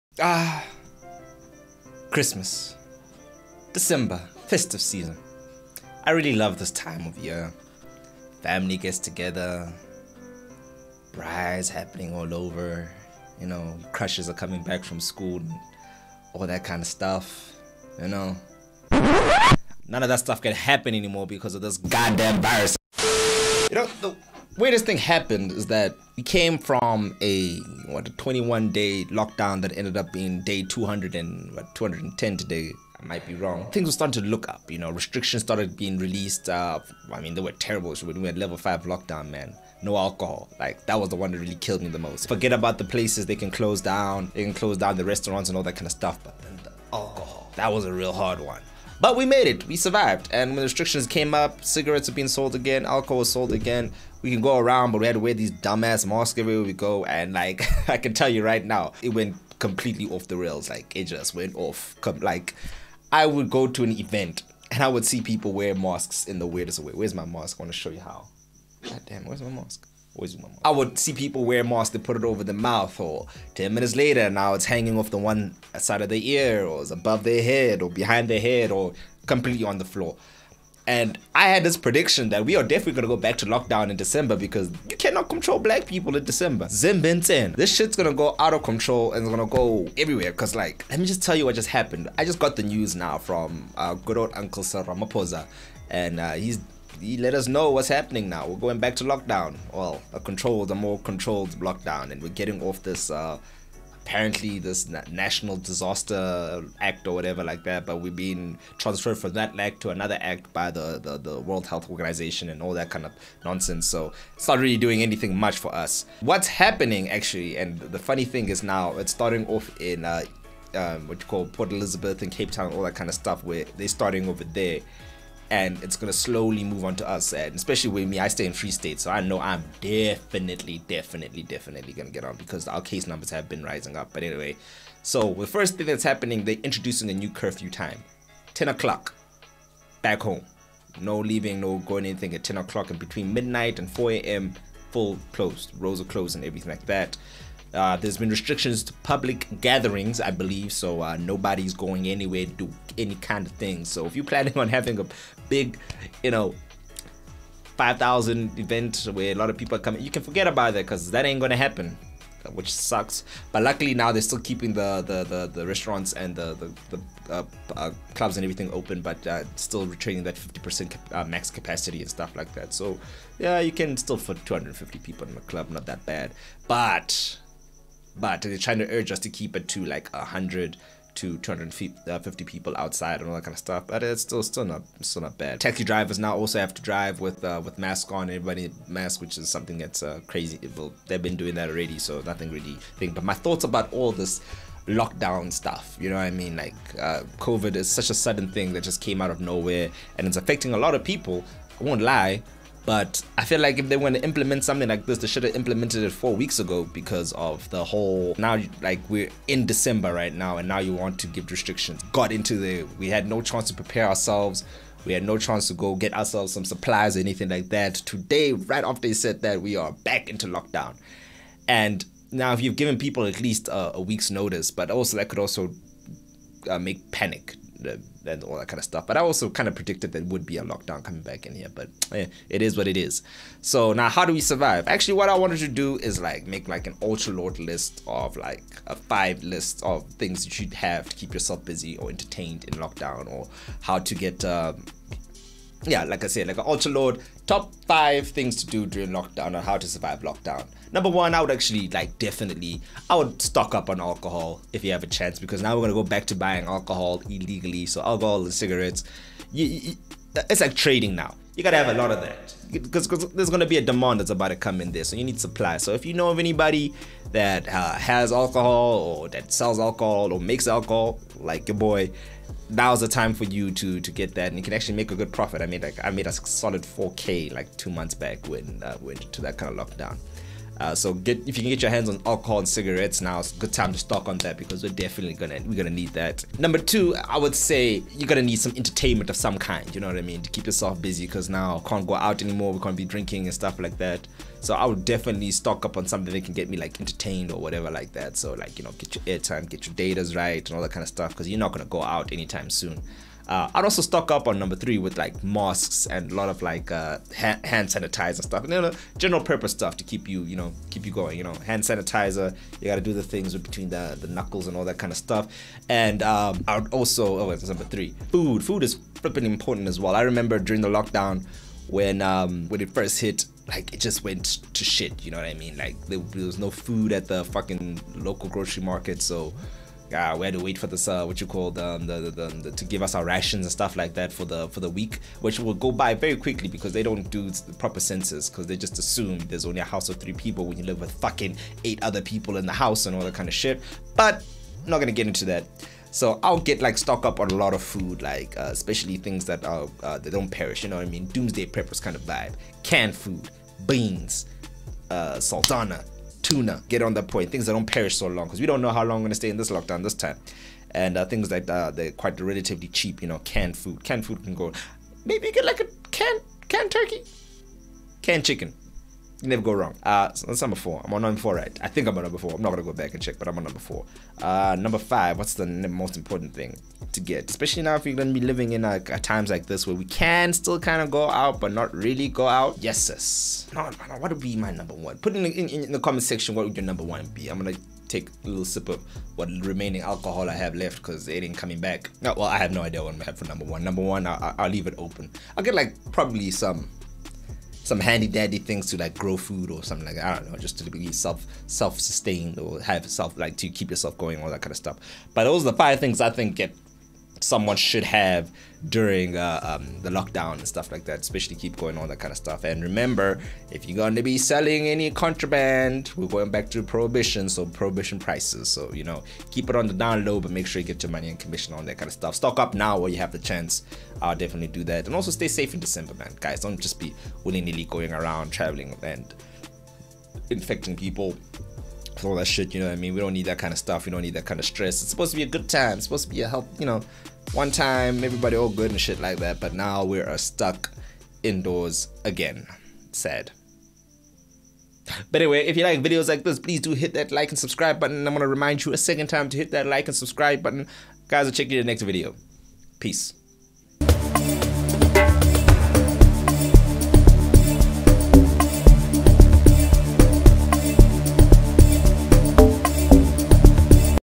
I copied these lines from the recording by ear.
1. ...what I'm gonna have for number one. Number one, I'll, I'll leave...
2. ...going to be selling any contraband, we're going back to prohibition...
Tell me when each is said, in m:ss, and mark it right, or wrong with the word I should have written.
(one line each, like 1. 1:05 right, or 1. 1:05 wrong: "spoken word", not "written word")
1. 6:33 right
2. 6:53 right.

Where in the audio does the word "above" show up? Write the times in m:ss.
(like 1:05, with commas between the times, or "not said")
1:16.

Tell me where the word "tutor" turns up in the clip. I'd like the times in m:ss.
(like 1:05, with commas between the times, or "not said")
not said.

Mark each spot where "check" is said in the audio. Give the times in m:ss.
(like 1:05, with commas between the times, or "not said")
6:13, 7:31.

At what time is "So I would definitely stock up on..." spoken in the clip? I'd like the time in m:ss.
4:54.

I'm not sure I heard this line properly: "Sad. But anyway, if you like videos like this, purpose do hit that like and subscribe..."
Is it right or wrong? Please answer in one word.
wrong.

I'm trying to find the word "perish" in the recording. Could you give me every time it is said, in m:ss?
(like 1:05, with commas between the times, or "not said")
5:50, 5:57.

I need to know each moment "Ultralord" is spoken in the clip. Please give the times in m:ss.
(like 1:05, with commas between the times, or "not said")
3:56, 4:06.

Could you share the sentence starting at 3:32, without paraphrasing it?
Got into the we had no chance to prepare ourselves.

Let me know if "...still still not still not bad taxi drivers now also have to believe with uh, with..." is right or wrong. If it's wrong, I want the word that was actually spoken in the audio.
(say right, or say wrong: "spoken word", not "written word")
wrong: "drive", not "believe".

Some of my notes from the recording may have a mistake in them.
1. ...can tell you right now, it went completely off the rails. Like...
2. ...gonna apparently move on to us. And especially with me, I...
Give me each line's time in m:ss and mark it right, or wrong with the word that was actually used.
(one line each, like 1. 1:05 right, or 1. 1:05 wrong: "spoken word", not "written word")
1. 0:57 right
2. 2:05 wrong: "slowly", not "apparently".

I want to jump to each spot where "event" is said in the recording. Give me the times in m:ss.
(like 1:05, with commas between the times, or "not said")
1:03, 2:38.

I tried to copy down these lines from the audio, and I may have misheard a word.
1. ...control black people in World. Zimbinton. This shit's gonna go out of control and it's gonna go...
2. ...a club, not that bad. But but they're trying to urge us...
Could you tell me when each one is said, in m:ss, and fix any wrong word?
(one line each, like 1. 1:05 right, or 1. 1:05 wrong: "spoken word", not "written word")
1. 1:25 wrong: "December", not "World"
2. 2:55 right.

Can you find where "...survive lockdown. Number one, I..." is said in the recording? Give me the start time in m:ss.
4:09.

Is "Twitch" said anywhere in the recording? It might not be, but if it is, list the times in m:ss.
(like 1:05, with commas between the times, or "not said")
not said.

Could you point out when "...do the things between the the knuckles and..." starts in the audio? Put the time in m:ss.
5:13.